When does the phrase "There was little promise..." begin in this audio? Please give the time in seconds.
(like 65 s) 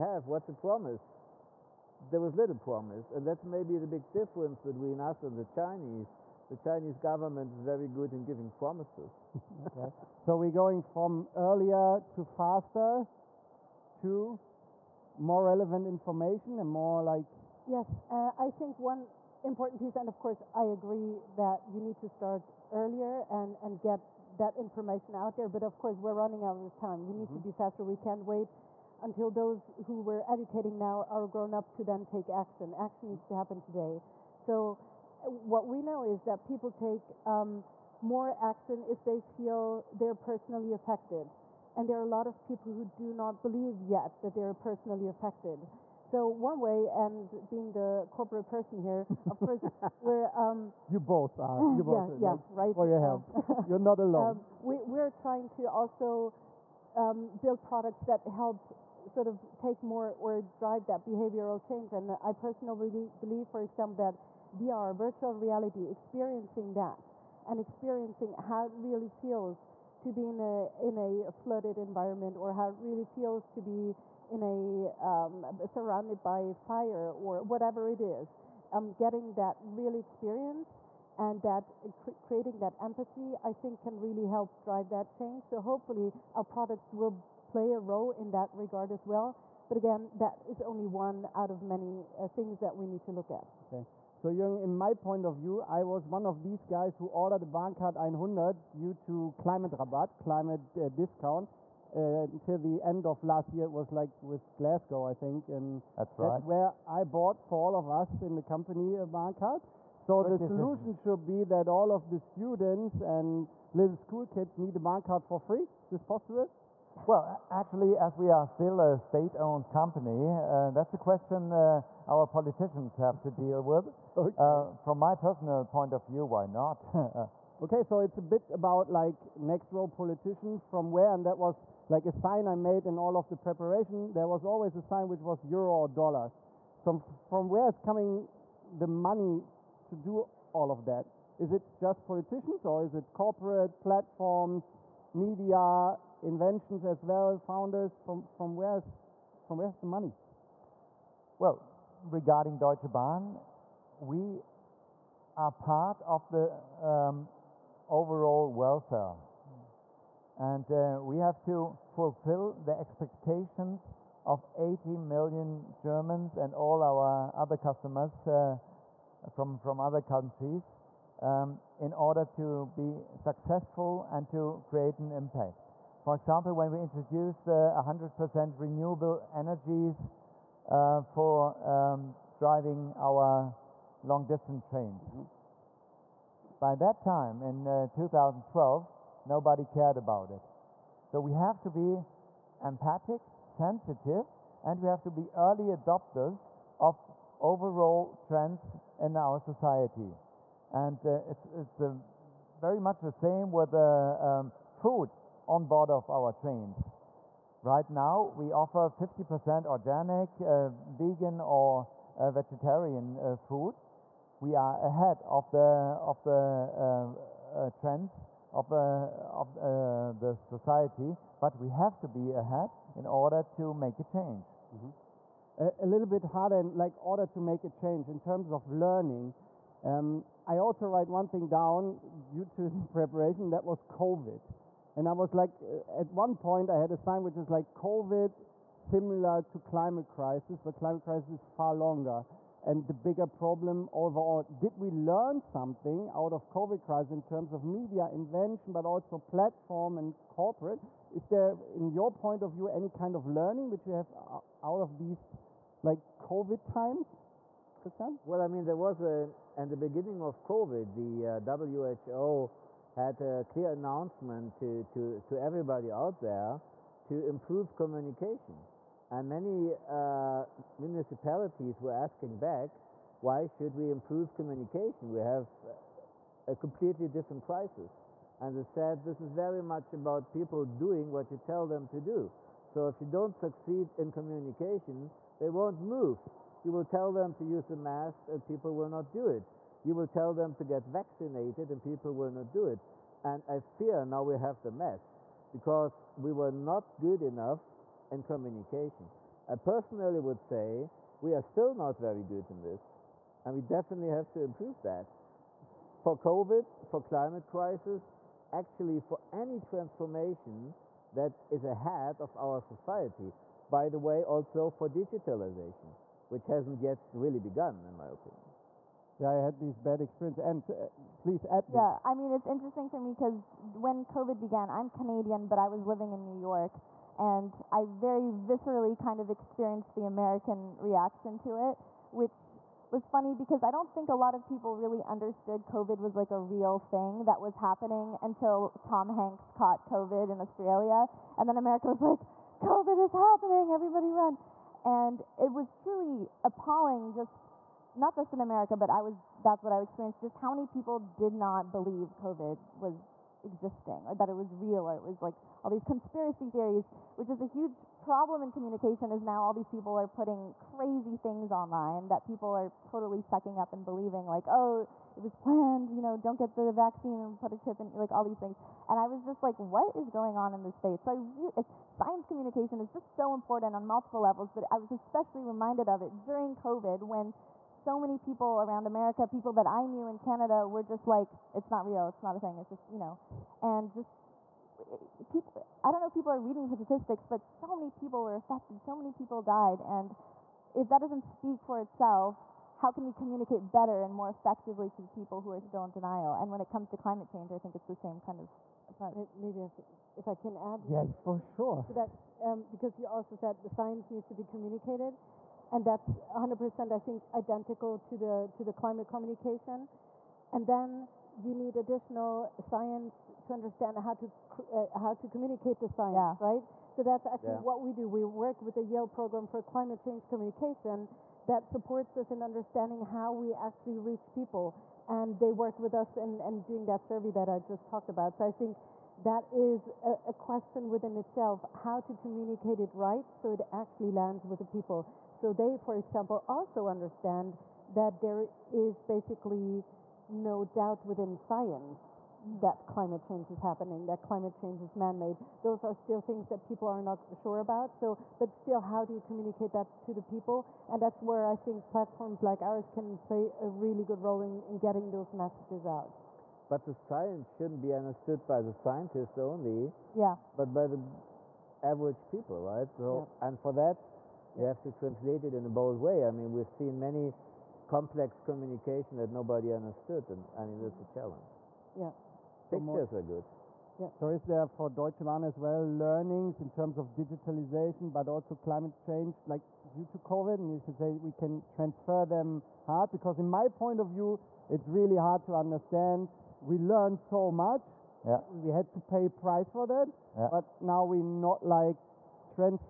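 2 s.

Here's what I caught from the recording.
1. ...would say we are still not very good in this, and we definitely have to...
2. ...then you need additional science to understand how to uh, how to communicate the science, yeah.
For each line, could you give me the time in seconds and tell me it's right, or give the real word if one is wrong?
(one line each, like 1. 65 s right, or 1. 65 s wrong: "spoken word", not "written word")
1. 300 s right
2. 410 s right.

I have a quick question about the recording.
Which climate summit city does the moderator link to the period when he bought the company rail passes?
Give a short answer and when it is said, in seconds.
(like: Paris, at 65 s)
Glasgow, at 104 s.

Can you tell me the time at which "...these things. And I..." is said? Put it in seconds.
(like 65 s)
368 s.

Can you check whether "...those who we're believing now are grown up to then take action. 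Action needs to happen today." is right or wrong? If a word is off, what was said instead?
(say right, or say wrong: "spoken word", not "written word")
wrong: "educating", not "believing".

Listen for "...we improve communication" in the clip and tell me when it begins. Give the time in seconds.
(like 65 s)
273 s.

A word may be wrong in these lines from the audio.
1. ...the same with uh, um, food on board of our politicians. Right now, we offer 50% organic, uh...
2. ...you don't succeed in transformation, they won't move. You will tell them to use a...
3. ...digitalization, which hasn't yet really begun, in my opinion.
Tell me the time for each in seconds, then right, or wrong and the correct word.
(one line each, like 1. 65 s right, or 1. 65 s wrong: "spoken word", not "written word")
1. 202 s wrong: "trains", not "politicians"
2. 282 s wrong: "communication", not "transformation"
3. 314 s right.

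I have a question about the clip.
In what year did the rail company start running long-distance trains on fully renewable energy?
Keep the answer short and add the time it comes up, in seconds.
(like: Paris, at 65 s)
2012, at 187 s.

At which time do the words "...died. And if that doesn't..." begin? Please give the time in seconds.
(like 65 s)
389 s.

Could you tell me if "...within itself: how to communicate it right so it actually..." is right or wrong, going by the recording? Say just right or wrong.
right.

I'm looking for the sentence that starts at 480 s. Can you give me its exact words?
And you can say we can transfer them hard because in my point of view, it's really hard to understand.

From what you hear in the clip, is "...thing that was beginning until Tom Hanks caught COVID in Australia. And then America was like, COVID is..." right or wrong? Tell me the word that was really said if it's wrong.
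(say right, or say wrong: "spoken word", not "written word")
wrong: "happening", not "beginning".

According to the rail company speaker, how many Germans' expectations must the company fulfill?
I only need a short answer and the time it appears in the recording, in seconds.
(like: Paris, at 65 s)
80 million, at 164 s.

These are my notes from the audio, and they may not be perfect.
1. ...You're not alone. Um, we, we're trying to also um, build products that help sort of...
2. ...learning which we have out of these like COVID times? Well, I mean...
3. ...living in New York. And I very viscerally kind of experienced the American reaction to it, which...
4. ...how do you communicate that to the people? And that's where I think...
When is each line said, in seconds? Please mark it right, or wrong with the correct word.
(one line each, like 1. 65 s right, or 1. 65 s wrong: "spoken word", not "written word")
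1. 53 s right
2. 253 s right
3. 325 s right
4. 448 s right.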